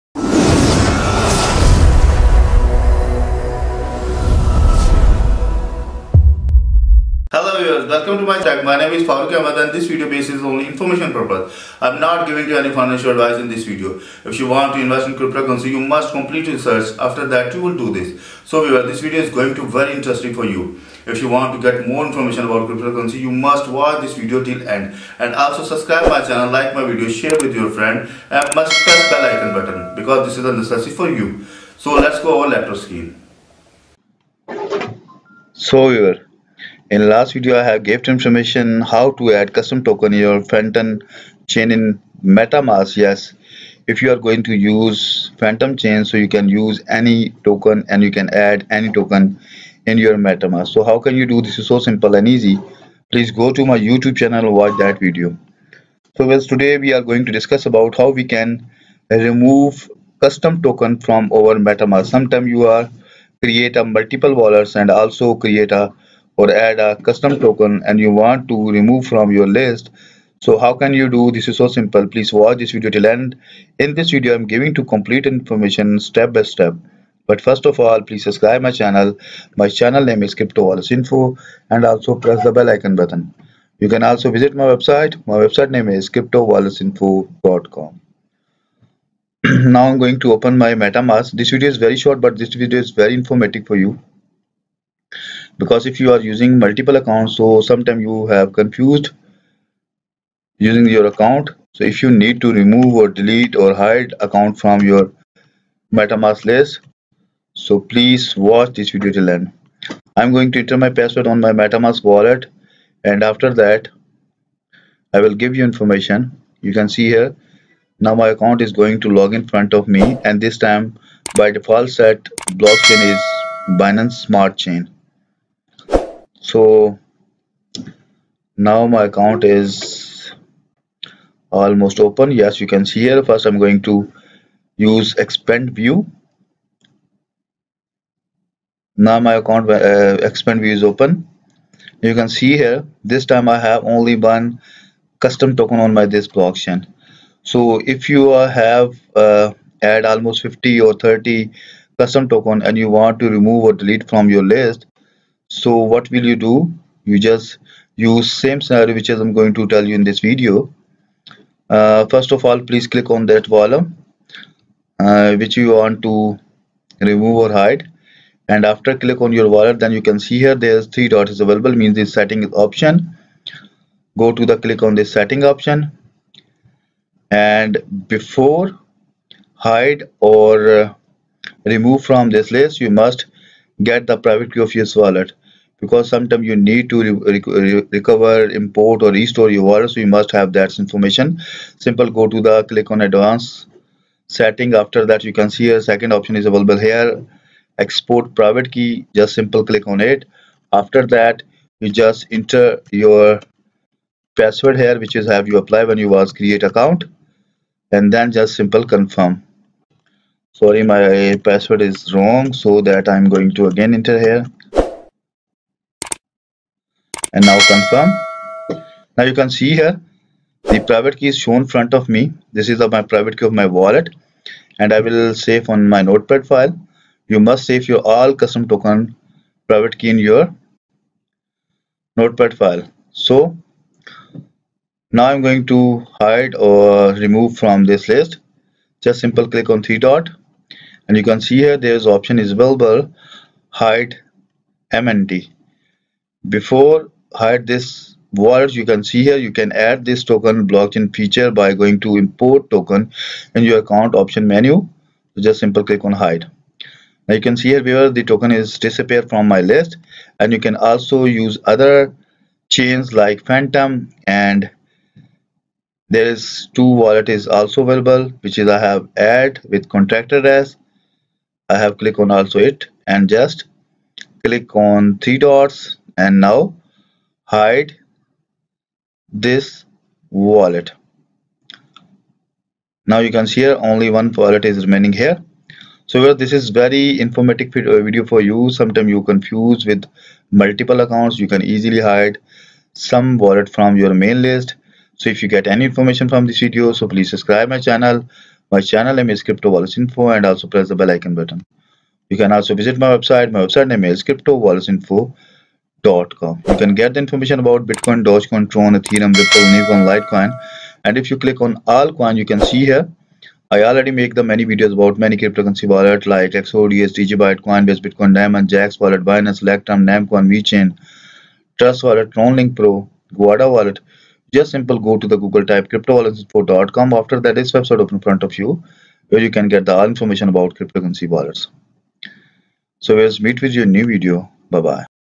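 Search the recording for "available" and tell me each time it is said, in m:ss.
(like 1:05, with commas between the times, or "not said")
2:51, 3:16, 4:02, 4:27.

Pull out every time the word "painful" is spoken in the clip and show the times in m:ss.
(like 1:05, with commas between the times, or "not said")
not said.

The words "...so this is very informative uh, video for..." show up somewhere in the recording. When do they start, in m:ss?
4:46.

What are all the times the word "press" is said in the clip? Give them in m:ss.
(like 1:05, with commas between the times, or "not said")
0:28, 1:22, 5:00.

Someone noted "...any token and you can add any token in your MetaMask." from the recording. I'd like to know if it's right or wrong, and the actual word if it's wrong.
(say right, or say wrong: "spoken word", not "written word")
right.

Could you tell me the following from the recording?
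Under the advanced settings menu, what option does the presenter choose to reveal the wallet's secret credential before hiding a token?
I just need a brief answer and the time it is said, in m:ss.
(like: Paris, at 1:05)
Export private key, at 3:17.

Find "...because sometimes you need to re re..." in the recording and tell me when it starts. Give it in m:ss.
3:05.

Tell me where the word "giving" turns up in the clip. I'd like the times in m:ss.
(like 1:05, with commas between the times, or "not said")
0:12, 1:14.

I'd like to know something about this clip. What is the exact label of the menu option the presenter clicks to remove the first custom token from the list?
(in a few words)
Hide MNT.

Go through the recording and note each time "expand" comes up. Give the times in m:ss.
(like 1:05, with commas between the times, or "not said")
2:15, 2:20.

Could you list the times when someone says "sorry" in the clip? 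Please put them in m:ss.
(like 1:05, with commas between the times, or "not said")
3:30.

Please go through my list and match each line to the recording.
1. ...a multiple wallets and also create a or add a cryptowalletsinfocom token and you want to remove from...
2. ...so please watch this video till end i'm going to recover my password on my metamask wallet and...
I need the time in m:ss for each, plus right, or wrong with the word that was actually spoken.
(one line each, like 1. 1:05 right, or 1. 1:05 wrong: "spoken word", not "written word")
1. 1:03 wrong: "custom", not "cryptowalletsinfocom"
2. 1:47 wrong: "enter", not "recover".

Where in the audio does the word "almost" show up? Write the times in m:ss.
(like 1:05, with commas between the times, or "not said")
2:11, 2:30.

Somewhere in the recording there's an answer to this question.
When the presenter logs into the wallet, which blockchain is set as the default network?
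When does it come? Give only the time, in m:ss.
2:03.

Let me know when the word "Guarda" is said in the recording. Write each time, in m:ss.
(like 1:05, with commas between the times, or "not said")
5:23.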